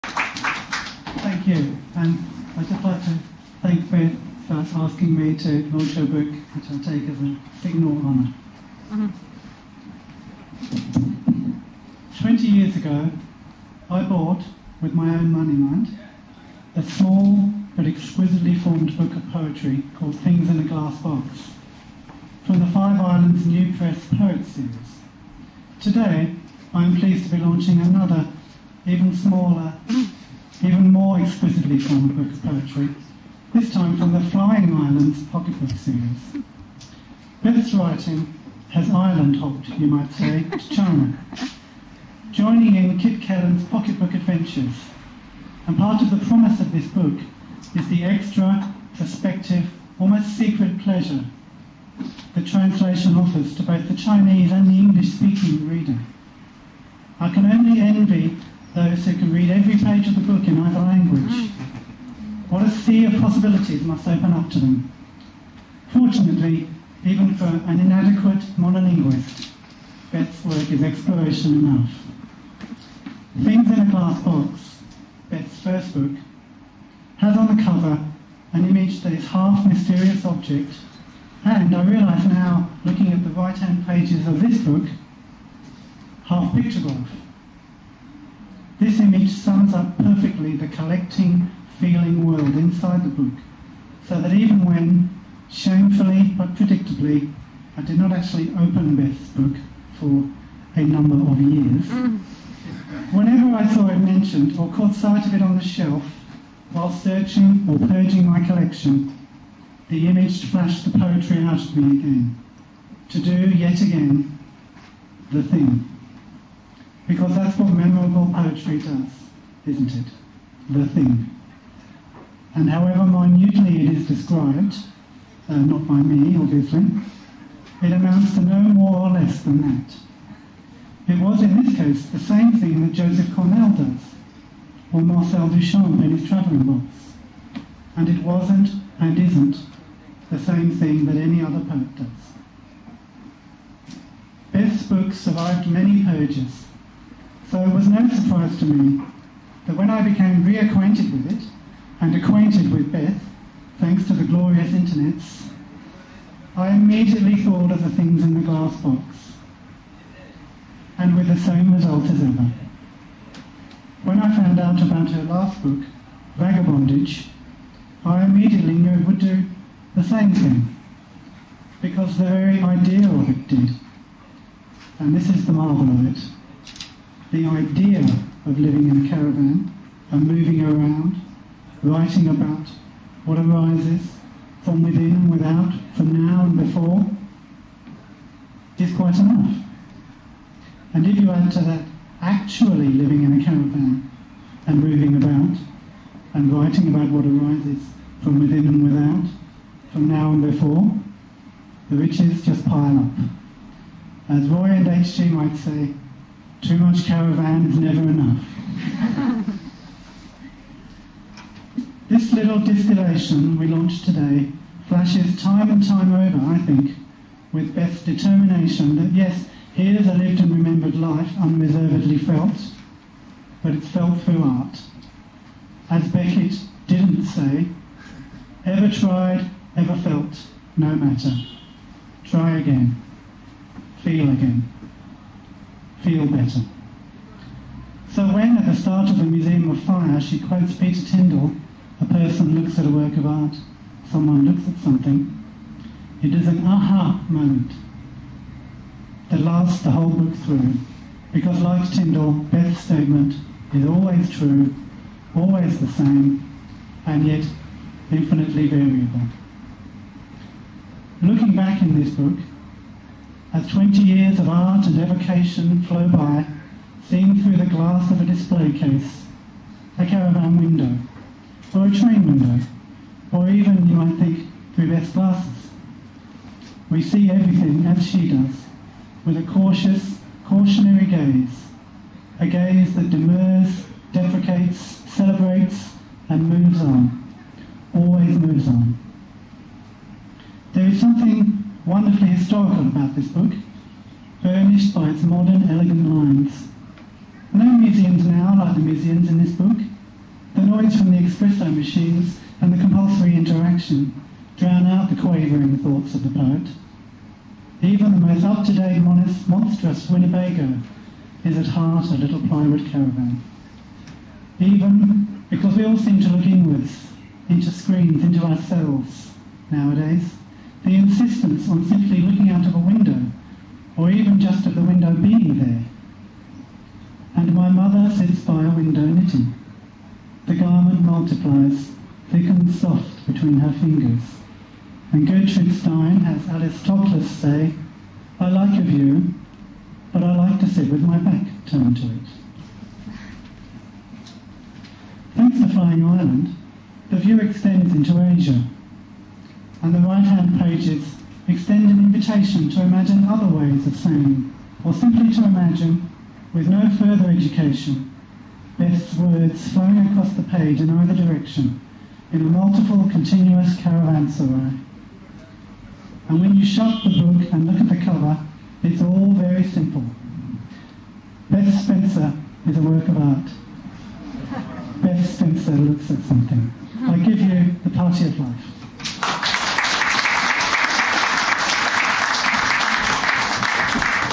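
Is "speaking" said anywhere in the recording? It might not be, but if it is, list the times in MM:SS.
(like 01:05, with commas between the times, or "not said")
00:54.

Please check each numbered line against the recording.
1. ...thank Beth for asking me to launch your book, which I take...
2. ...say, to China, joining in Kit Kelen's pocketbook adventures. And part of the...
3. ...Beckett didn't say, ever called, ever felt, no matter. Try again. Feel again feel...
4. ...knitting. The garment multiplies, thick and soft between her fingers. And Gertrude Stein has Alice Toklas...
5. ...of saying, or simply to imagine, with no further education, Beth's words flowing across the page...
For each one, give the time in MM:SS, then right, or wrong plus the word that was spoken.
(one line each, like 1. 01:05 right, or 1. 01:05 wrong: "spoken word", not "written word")
1. 00:03 right
2. 00:40 right
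3. 03:46 wrong: "tried", not "called"
4. 05:29 right
5. 05:53 right.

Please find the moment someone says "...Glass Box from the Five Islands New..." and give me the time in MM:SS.
00:20.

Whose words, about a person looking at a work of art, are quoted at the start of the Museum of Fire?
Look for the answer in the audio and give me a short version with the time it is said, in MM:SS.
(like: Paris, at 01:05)
Peter Tyndall, at 04:00.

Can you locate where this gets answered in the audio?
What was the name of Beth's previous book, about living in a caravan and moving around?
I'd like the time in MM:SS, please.
02:46.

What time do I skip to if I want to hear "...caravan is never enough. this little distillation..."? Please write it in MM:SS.
03:27.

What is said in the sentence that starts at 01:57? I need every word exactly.
Because that's what memorable poetry does, isn't it?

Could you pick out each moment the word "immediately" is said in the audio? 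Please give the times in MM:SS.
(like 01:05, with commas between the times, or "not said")
02:36, 02:48.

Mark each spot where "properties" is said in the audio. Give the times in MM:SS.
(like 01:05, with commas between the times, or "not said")
not said.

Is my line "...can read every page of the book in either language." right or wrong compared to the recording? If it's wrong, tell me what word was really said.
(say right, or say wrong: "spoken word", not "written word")
right.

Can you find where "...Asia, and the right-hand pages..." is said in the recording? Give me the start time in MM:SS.
05:48.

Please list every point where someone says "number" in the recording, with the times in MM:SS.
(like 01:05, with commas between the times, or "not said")
01:40.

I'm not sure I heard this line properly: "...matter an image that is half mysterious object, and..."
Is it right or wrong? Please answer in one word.
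wrong.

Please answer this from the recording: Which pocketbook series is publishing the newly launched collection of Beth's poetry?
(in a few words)
Flying Islands.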